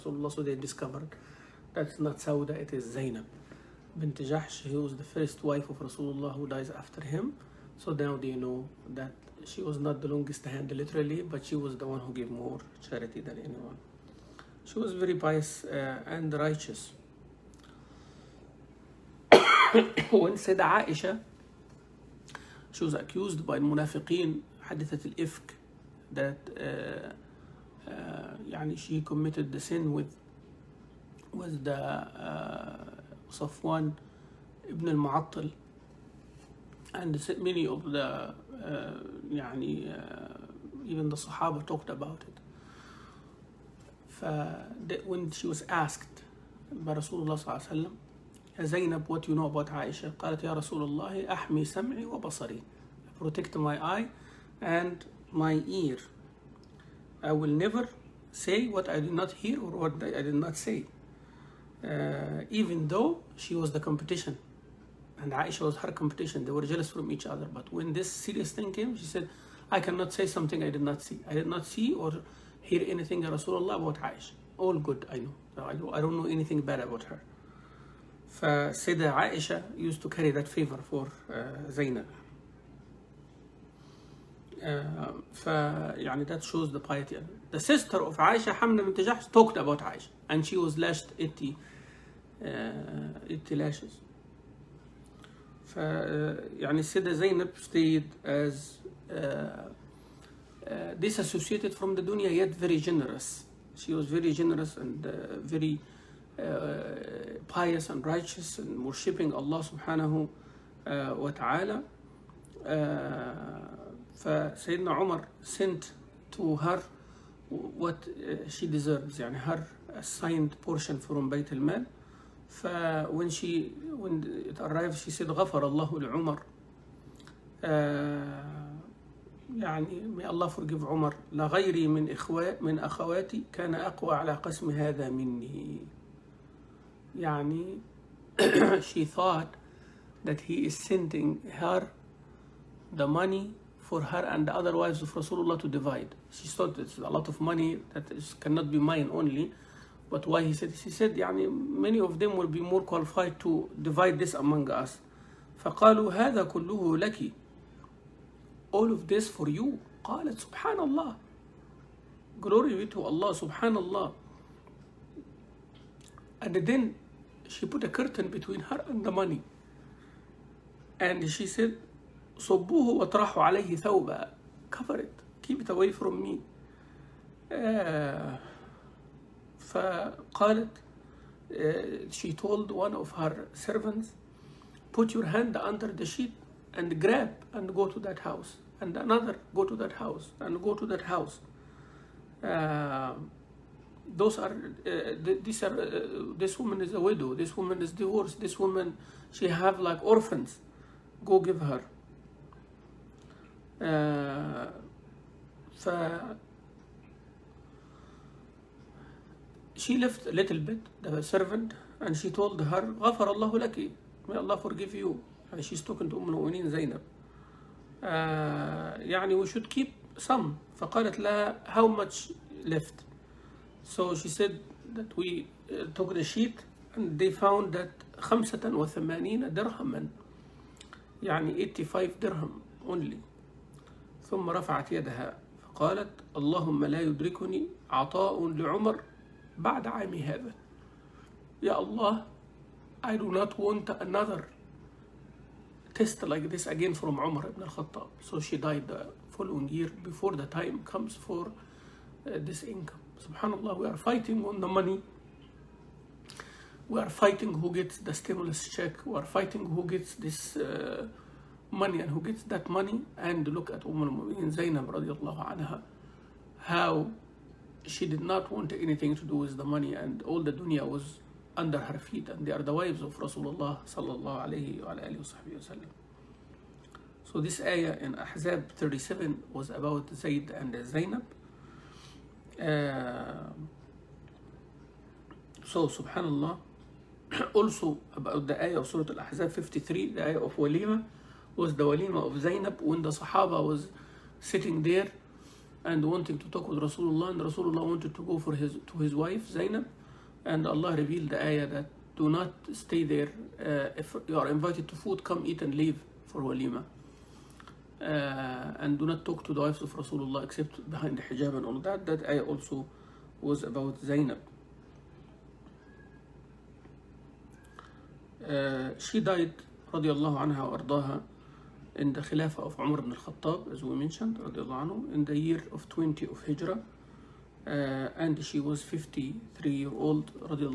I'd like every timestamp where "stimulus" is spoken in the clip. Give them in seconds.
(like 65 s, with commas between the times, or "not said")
258 s.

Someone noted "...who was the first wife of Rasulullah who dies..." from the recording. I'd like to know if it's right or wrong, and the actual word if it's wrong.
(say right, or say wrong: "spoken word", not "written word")
right.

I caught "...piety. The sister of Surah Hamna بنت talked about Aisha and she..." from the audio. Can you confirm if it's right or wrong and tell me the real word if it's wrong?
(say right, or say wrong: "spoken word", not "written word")
wrong: "Aisha", not "Surah".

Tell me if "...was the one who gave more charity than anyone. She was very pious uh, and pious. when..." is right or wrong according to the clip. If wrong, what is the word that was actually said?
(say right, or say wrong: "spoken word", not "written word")
wrong: "righteous", not "pious".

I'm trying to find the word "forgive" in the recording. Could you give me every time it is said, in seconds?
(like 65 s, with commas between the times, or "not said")
130 s, 214 s.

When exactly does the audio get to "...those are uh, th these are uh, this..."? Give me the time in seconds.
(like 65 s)
194 s.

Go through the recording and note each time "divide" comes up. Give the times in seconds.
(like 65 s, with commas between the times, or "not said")
145 s, 153 s.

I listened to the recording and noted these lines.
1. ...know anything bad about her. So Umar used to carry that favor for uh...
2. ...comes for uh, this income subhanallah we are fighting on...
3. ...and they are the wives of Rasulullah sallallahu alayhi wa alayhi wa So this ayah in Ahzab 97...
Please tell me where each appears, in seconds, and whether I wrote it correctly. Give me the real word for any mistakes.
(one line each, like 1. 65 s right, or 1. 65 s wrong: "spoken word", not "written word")
1. 76 s wrong: "Aisha", not "Umar"
2. 250 s right
3. 272 s wrong: "37", not "97".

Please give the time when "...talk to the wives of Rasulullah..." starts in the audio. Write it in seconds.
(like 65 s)
309 s.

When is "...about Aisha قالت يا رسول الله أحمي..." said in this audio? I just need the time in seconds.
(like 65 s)
49 s.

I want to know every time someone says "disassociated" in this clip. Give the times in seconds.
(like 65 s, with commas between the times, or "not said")
100 s.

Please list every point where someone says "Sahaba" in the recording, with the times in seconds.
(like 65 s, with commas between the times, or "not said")
41 s, 293 s.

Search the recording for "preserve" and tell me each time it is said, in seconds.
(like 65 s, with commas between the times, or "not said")
not said.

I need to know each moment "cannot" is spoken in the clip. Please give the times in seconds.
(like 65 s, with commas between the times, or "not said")
69 s, 148 s.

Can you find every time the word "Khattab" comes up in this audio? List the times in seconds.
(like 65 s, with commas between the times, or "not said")
247 s, 323 s.